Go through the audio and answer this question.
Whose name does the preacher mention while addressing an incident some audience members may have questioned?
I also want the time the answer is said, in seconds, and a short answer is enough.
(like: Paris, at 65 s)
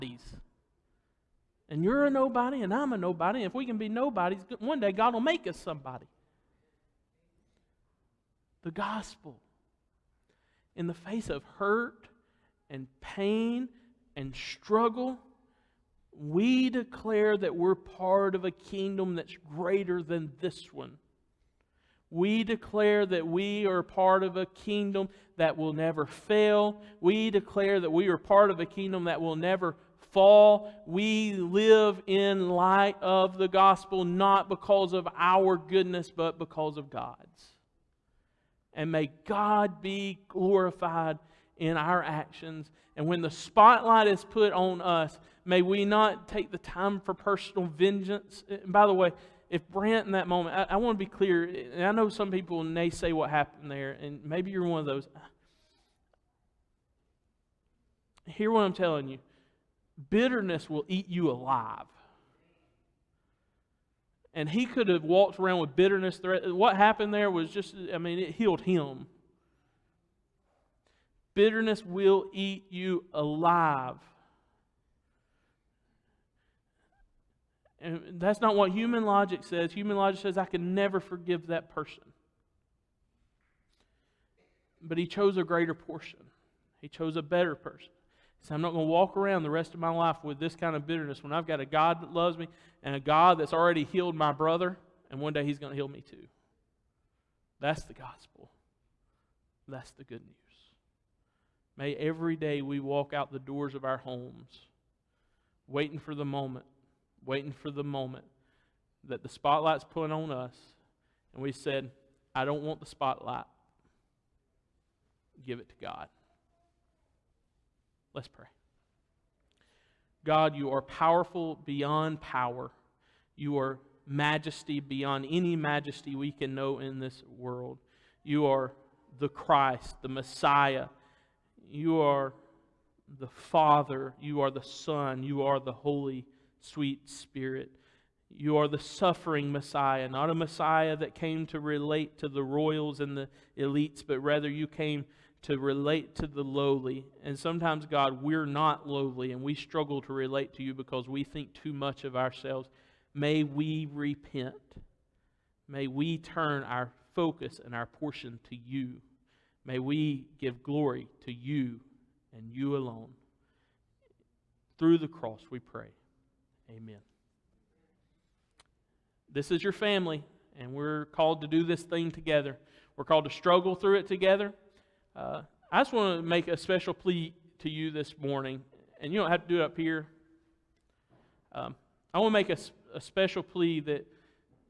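Brandt, at 49 s.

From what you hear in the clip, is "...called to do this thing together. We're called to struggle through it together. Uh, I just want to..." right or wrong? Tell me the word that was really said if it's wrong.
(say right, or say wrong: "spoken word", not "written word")
right.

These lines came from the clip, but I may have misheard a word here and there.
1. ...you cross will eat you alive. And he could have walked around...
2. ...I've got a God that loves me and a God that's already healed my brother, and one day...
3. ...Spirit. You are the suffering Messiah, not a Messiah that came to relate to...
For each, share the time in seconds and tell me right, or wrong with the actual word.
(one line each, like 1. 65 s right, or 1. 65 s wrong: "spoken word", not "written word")
1. 59 s wrong: "bitterness", not "cross"
2. 91 s right
3. 137 s right.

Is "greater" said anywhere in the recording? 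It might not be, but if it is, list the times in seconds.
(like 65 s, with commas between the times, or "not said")
19 s, 85 s.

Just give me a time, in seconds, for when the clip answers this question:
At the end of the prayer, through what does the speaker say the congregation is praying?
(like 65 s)
164 s.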